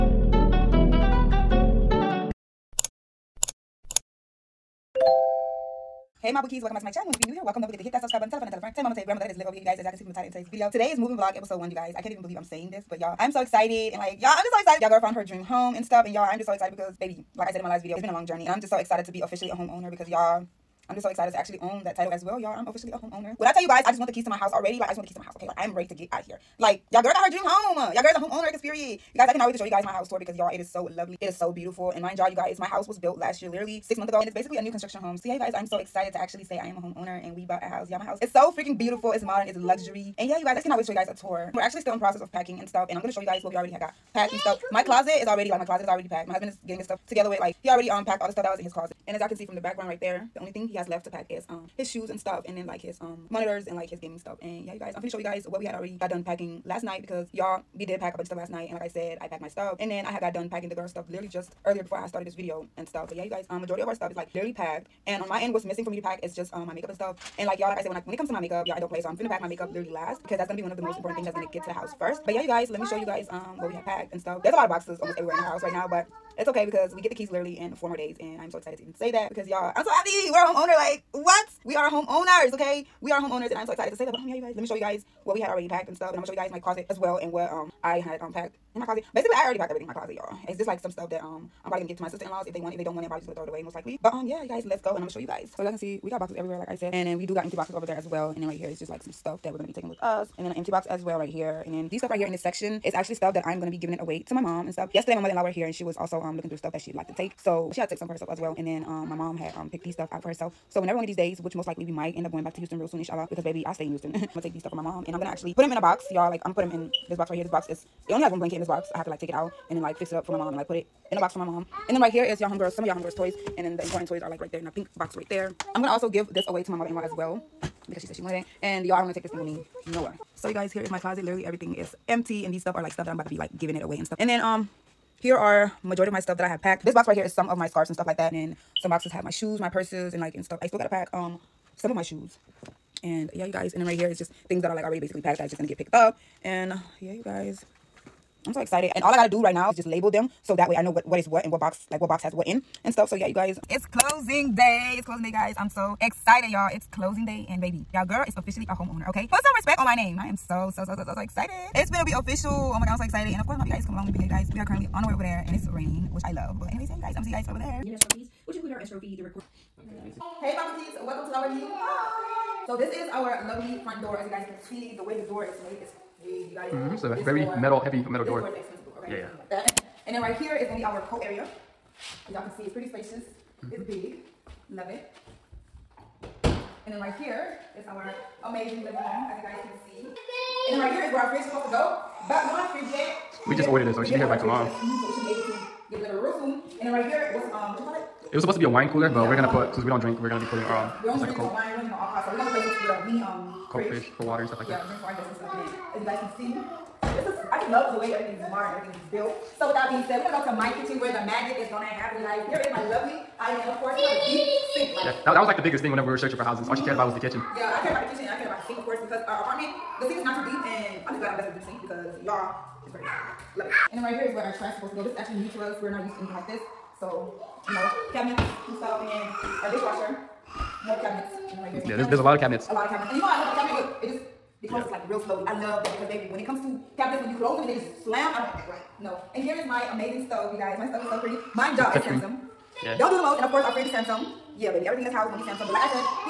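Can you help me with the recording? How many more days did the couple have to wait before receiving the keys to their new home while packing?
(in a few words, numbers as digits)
4.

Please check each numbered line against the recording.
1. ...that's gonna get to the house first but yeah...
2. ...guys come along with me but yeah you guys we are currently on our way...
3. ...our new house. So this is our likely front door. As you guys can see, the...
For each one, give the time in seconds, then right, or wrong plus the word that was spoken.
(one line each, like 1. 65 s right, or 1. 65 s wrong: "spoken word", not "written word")
1. 71 s right
2. 163 s right
3. 171 s wrong: "lovely", not "likely".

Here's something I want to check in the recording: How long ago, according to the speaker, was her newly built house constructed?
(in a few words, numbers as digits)
6 months ago.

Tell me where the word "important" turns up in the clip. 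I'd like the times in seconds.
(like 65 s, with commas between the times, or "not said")
70 s, 123 s.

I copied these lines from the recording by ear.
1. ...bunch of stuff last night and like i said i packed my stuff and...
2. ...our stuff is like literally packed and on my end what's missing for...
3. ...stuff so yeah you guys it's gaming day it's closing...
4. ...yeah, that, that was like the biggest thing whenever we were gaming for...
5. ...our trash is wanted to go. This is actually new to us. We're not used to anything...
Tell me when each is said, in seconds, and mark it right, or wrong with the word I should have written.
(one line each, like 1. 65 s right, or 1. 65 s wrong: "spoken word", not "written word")
1. 58 s right
2. 63 s right
3. 152 s wrong: "closing", not "gaming"
4. 215 s wrong: "searching", not "gaming"
5. 224 s wrong: "supposed", not "wanted".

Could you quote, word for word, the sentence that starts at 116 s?
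Like I'm gonna put them in this box right here.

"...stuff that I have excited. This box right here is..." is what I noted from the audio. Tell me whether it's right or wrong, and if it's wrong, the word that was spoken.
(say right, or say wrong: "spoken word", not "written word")
wrong: "packed", not "excited".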